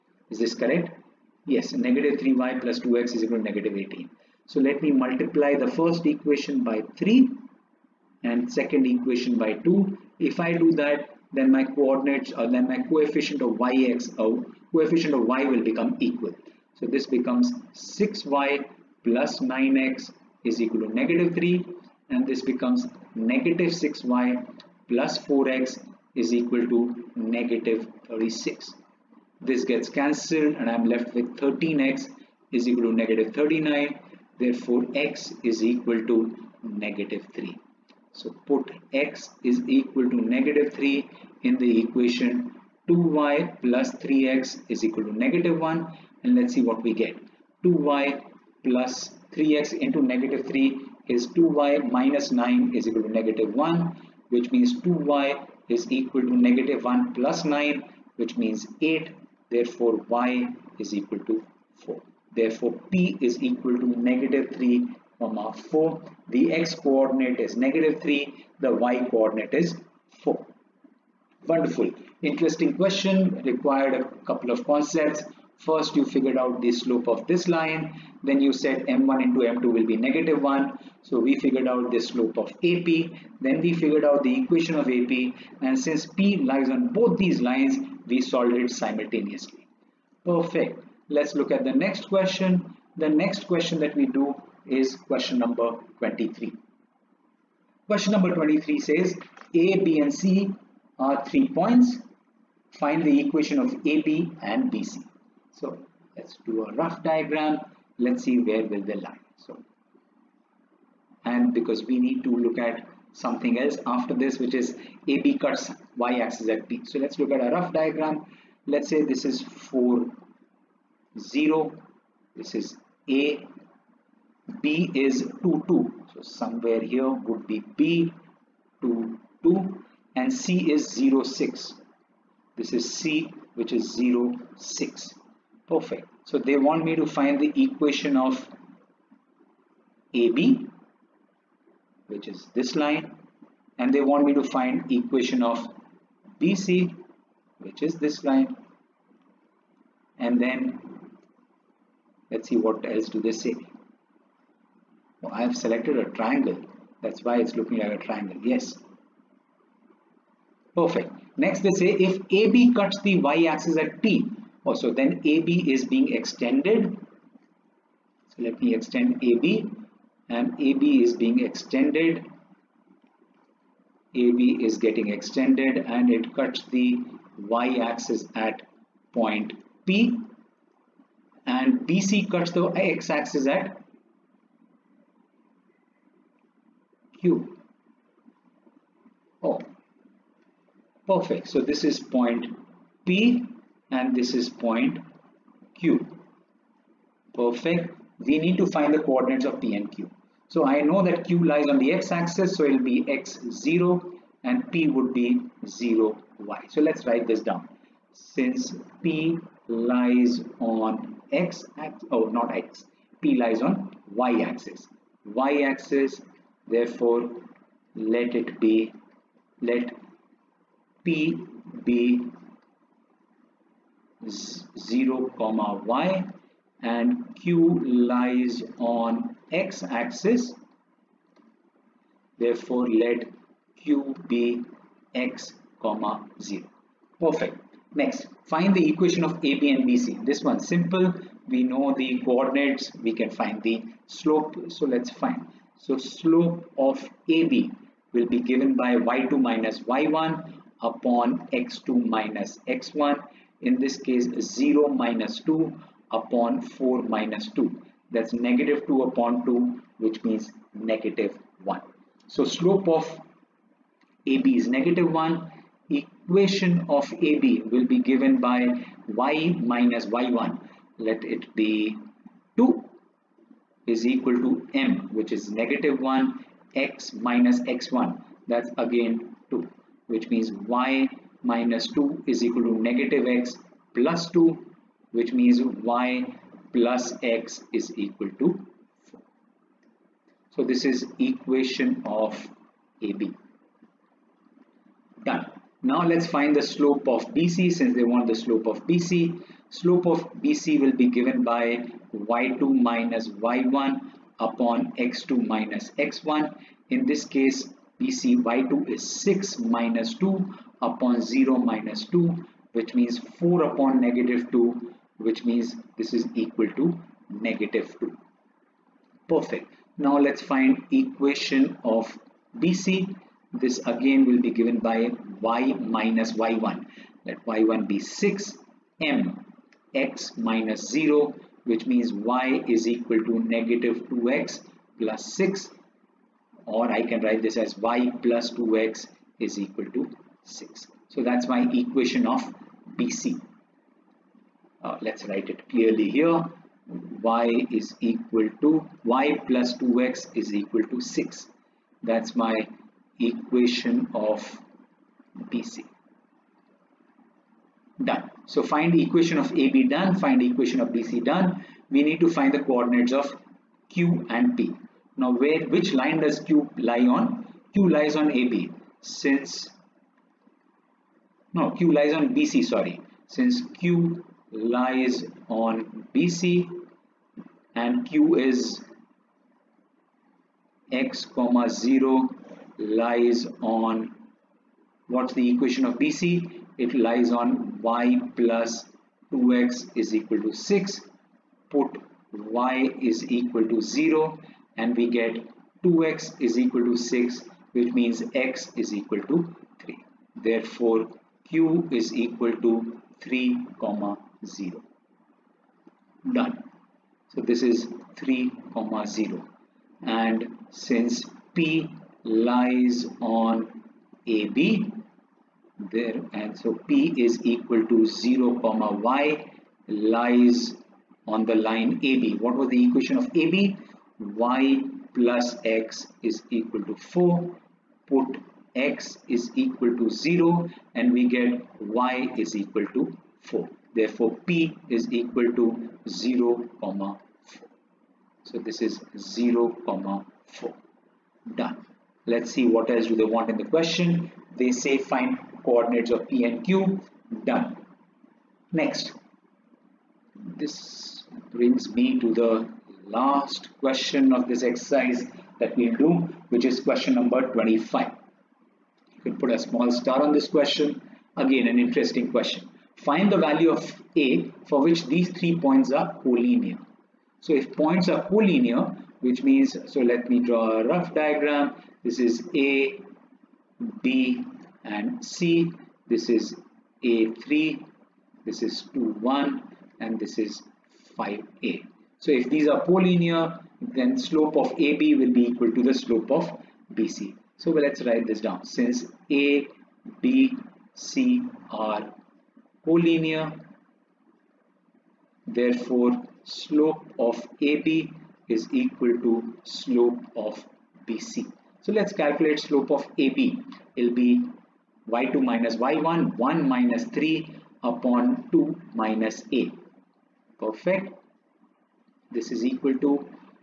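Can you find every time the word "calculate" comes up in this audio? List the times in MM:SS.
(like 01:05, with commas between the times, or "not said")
08:22.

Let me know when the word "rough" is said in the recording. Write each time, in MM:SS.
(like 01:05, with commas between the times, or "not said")
01:46, 01:57, 07:50.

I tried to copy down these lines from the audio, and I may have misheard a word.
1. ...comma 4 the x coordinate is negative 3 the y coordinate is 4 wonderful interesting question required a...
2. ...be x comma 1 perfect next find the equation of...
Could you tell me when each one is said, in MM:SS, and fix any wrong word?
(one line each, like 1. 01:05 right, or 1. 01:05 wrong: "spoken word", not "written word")
1. 01:05 right
2. 03:54 wrong: "0", not "1".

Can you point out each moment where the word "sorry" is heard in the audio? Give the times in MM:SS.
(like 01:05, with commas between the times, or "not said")
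06:12.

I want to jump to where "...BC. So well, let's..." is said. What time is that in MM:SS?
08:06.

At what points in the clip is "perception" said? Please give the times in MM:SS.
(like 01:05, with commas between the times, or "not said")
not said.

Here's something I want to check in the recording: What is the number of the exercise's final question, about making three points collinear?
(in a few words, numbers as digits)
25.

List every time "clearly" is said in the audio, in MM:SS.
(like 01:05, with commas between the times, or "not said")
05:45.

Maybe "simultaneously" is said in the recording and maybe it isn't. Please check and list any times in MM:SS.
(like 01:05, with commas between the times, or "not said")
01:28.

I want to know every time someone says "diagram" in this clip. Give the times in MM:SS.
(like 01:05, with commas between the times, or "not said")
01:47, 01:57, 07:51.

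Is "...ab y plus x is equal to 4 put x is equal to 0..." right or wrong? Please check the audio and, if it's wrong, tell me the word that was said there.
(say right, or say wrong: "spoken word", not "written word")
right.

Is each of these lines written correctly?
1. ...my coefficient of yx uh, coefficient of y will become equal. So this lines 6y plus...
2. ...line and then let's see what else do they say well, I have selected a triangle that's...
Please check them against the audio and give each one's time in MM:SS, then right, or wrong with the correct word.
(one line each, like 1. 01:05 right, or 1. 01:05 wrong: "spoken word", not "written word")
1. 00:12 wrong: "becomes", not "lines"
2. 02:28 right.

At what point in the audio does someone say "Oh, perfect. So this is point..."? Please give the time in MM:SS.
03:09.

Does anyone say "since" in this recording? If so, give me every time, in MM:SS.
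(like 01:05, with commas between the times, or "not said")
01:25, 03:28, 04:57, 06:09, 06:13, 06:50, 08:08.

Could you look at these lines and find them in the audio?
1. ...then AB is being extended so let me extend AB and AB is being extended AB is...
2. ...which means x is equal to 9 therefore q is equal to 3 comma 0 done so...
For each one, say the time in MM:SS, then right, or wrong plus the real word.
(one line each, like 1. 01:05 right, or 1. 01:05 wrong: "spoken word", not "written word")
1. 02:44 right
2. 06:37 wrong: "3", not "9".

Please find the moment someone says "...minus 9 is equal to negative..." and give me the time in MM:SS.
00:51.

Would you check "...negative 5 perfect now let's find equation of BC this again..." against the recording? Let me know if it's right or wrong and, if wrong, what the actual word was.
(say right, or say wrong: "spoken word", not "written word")
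wrong: "2", not "5".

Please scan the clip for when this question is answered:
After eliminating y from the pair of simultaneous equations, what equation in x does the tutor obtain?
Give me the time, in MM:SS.
00:31.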